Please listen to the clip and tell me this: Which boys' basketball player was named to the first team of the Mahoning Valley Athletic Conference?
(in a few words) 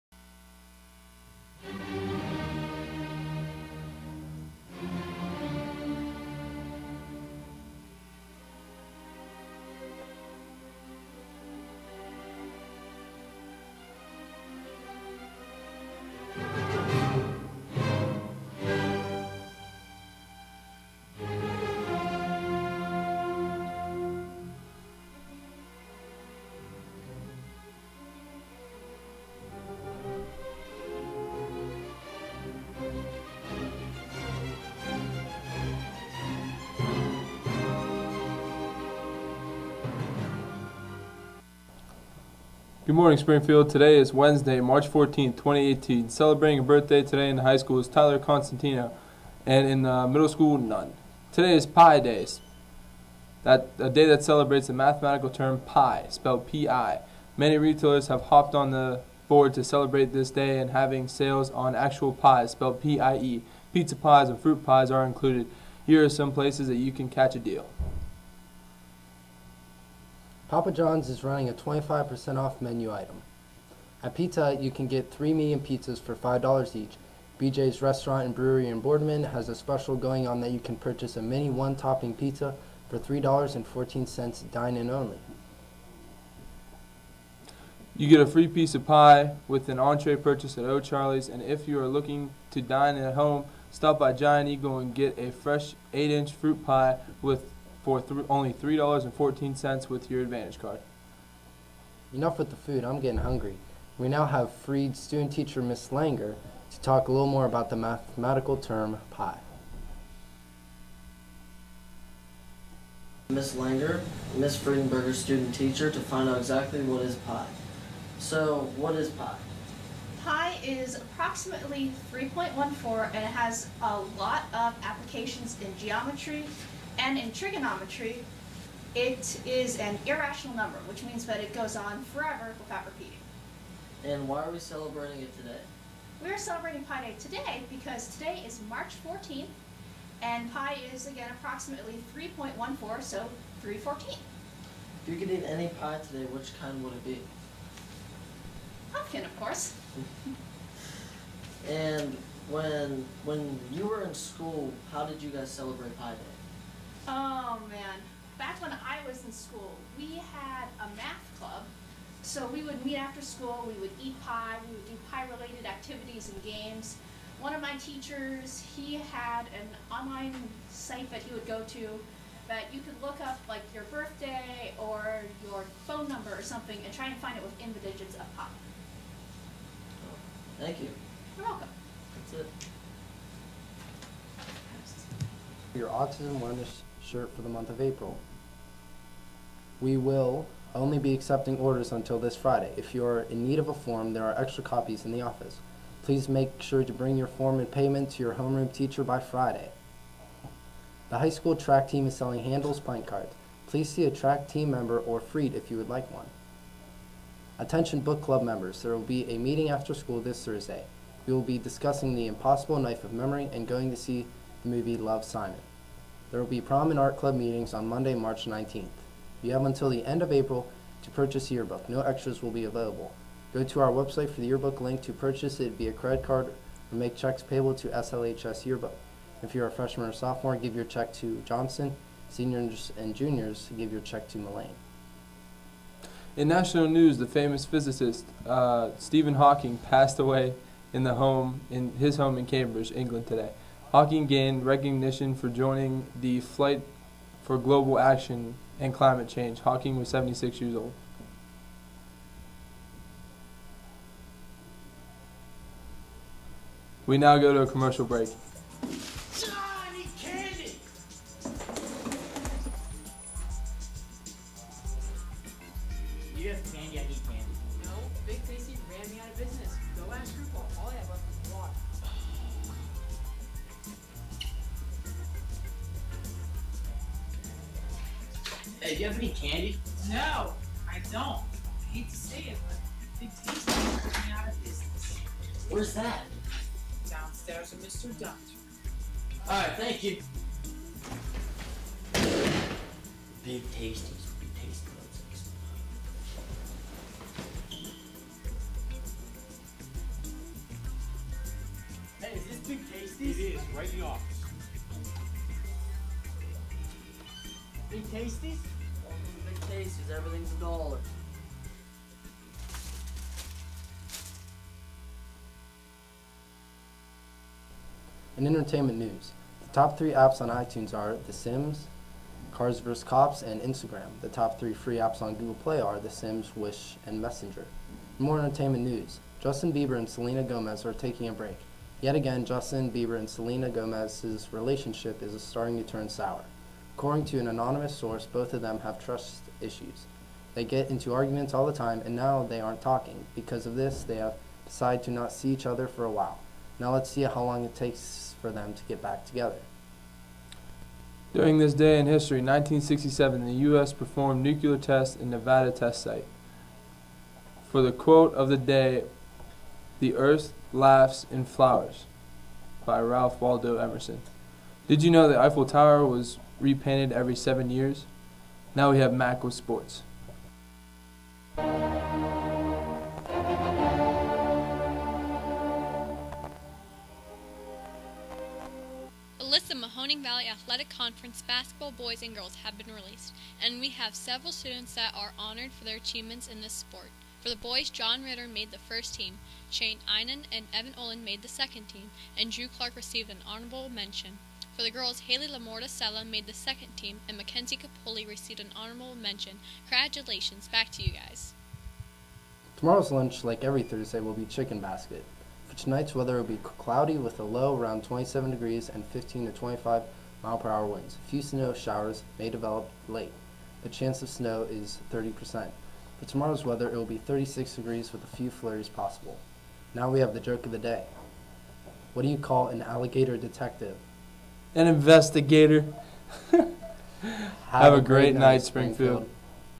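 John Ritter.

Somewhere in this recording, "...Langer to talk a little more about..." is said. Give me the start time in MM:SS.
01:45.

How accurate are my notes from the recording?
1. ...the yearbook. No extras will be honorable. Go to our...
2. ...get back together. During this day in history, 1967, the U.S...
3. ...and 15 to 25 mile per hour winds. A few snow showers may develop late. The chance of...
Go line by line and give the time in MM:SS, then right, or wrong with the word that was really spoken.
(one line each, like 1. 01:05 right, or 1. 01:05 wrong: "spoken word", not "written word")
1. 03:41 wrong: "available", not "honorable"
2. 05:48 right
3. 06:48 right.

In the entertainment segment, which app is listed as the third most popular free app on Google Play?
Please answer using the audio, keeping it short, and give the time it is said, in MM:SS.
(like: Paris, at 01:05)
Messenger, at 05:27.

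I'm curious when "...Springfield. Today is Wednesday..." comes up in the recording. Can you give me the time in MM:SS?
00:43.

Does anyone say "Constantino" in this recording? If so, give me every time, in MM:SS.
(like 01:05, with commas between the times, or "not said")
00:48.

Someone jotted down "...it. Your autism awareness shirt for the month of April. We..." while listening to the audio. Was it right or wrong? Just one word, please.
right.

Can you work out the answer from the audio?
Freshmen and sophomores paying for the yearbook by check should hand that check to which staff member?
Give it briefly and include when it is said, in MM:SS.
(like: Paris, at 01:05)
Johnson, at 03:51.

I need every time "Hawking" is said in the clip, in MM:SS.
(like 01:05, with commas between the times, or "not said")
03:59, 04:03, 04:09.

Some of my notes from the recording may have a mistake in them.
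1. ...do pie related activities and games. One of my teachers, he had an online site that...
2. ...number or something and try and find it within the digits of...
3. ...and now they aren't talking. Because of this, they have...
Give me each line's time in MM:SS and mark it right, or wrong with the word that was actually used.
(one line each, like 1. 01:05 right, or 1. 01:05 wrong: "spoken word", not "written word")
1. 02:44 right
2. 02:56 right
3. 05:42 right.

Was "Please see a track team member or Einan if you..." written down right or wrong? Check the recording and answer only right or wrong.
wrong.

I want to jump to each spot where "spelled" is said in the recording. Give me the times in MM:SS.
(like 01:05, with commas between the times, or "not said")
00:56, 01:02.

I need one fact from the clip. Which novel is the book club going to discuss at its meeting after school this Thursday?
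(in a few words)
The Impossible Knife of Memory.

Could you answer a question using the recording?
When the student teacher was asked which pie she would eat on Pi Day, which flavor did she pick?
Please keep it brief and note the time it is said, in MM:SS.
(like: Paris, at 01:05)
Pumpkin, at 02:28.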